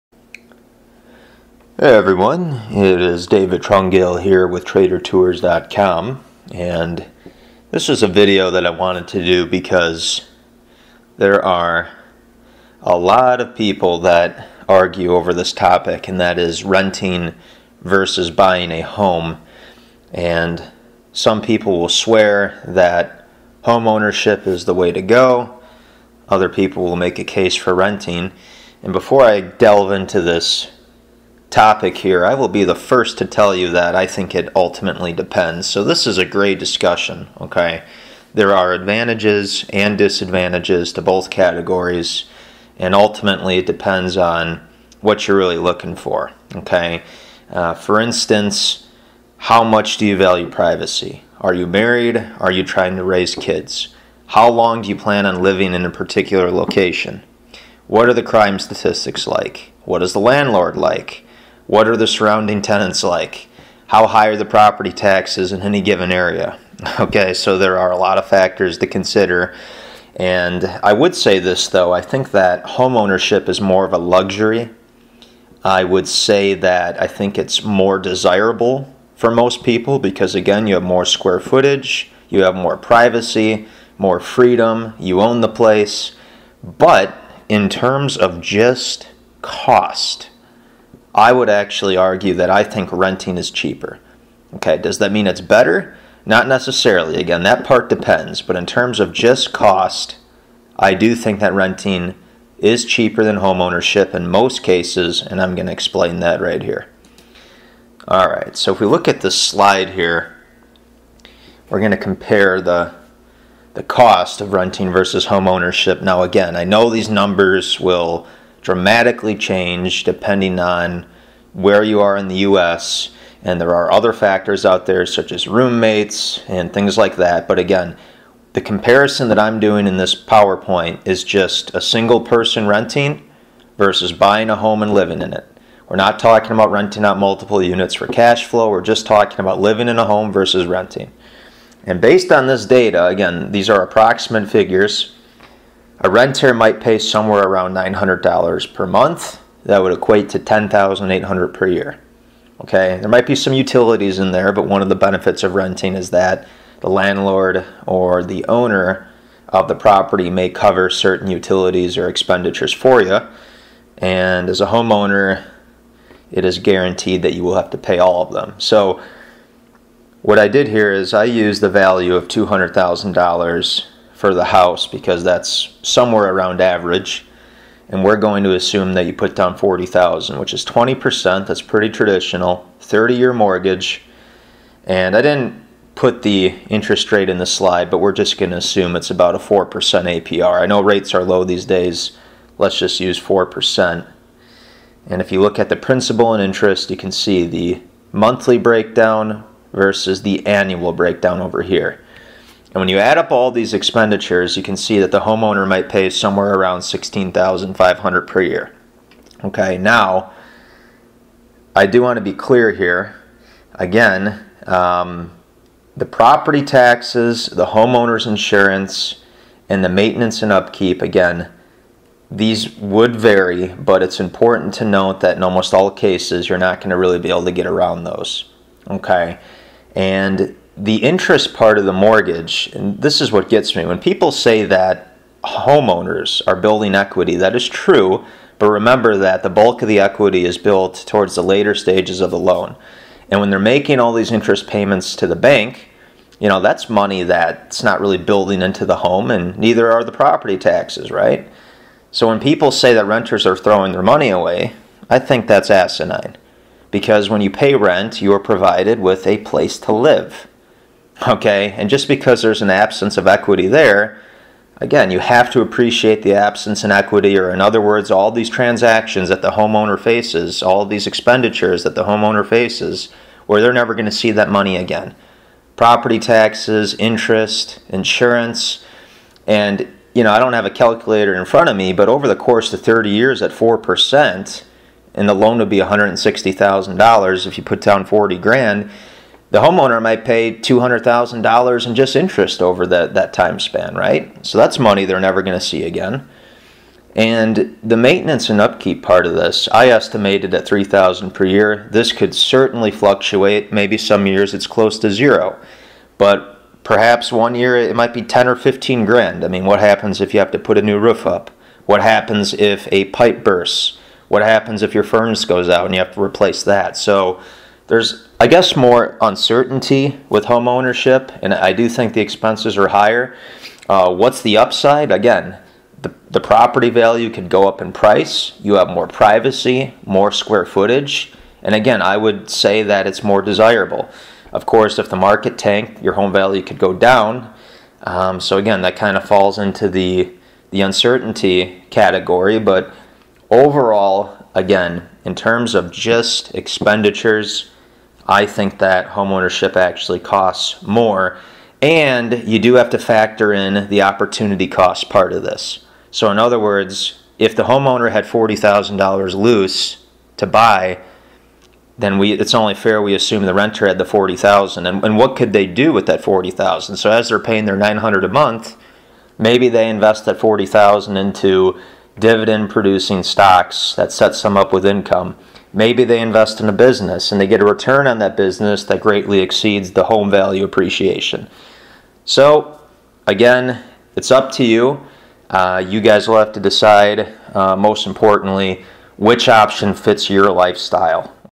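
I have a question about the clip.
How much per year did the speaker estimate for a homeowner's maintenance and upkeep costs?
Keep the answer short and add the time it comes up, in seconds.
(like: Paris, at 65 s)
3000, at 300 s.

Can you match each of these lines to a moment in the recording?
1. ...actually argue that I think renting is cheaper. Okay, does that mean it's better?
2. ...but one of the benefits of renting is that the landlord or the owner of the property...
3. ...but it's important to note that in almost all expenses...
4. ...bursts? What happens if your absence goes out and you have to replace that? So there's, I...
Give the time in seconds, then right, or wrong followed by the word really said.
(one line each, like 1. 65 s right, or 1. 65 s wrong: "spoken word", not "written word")
1. 91 s right
2. 154 s right
3. 223 s wrong: "cases", not "expenses"
4. 313 s wrong: "furnace", not "absence".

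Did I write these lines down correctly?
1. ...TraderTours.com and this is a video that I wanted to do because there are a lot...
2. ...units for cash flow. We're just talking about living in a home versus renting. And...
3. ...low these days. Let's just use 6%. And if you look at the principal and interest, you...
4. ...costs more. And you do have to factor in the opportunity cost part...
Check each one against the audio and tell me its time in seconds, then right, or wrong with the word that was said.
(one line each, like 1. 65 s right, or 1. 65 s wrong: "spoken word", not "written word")
1. 4 s right
2. 137 s right
3. 191 s wrong: "4", not "6"
4. 350 s right.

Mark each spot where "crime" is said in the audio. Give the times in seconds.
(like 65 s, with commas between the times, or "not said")
58 s.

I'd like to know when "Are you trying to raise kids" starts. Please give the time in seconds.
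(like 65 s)
52 s.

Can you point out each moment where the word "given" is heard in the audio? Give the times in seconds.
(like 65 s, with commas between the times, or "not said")
65 s.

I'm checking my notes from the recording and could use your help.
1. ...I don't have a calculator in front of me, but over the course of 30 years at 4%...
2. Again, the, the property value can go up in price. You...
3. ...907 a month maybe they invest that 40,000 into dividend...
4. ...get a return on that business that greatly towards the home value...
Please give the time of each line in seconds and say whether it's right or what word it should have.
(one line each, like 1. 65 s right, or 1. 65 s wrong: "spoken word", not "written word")
1. 280 s right
2. 325 s right
3. 367 s wrong: "900", not "907"
4. 377 s wrong: "exceeds", not "towards".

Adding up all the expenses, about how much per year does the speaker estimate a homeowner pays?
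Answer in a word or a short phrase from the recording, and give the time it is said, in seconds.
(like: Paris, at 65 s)
16,500, at 206 s.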